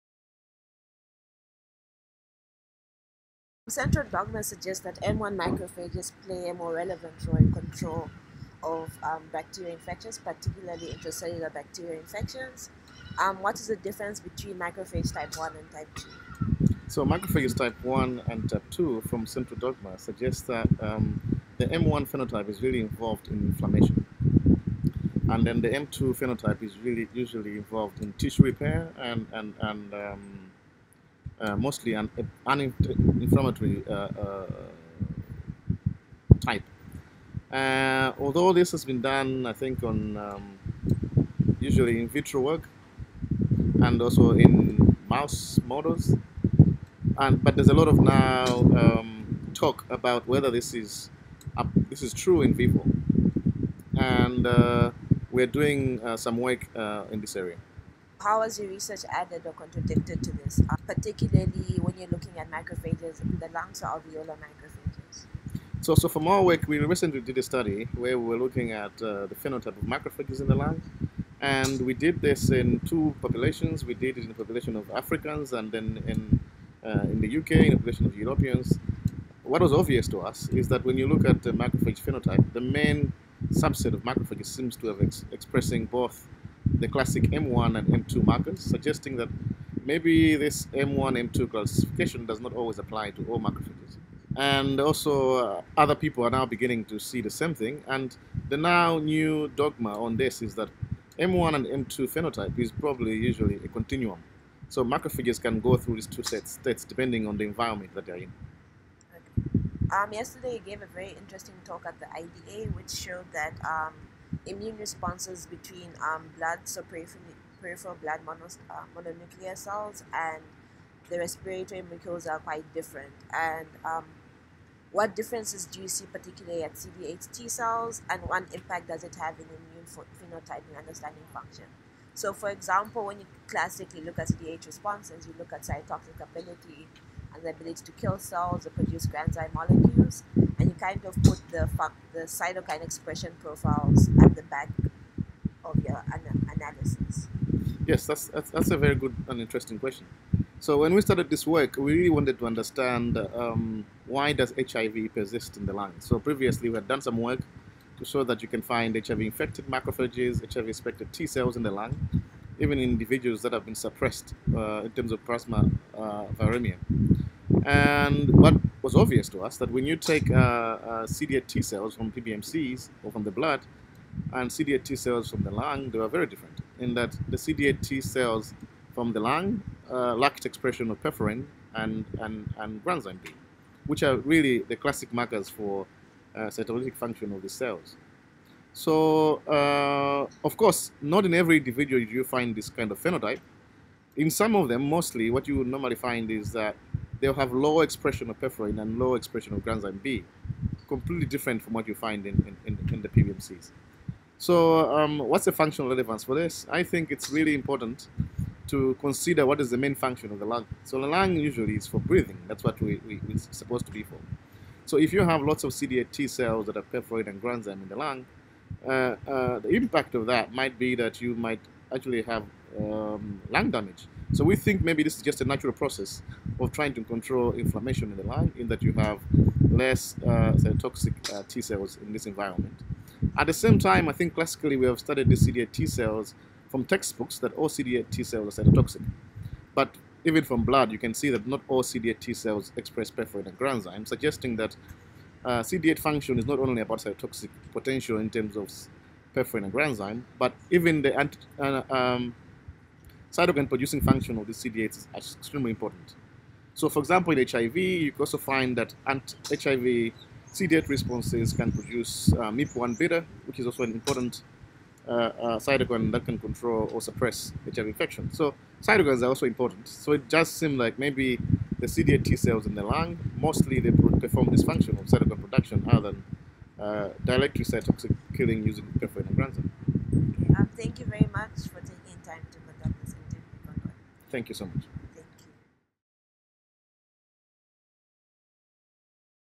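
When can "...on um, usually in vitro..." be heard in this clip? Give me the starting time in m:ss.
0:39.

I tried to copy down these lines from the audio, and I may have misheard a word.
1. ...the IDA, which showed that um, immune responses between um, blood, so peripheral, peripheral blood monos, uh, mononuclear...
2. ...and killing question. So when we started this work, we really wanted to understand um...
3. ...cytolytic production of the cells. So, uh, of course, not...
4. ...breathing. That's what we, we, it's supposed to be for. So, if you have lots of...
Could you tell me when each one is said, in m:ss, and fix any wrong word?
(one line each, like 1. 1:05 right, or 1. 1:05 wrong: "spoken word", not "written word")
1. 1:51 right
2. 2:29 wrong: "interesting", not "killing"
3. 3:06 wrong: "function", not "production"
4. 3:31 right.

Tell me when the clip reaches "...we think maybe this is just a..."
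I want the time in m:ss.
3:44.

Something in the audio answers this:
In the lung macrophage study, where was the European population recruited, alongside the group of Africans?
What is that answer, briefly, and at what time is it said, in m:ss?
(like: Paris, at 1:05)
UK, at 1:17.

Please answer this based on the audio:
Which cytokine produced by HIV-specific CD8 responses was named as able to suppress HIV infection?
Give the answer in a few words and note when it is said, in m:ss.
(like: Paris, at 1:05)
MIP1 beta, at 4:22.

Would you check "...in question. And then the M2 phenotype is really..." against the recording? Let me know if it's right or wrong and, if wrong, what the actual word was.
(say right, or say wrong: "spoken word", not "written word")
wrong: "inflammation", not "question".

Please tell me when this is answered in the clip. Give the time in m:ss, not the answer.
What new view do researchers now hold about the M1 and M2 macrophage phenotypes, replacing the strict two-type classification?
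1:43.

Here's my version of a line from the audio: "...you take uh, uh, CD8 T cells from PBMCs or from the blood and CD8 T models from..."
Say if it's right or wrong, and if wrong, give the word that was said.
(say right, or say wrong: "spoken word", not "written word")
wrong: "cells", not "models".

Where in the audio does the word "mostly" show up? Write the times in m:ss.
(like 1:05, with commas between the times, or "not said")
0:31, 3:14, 4:33.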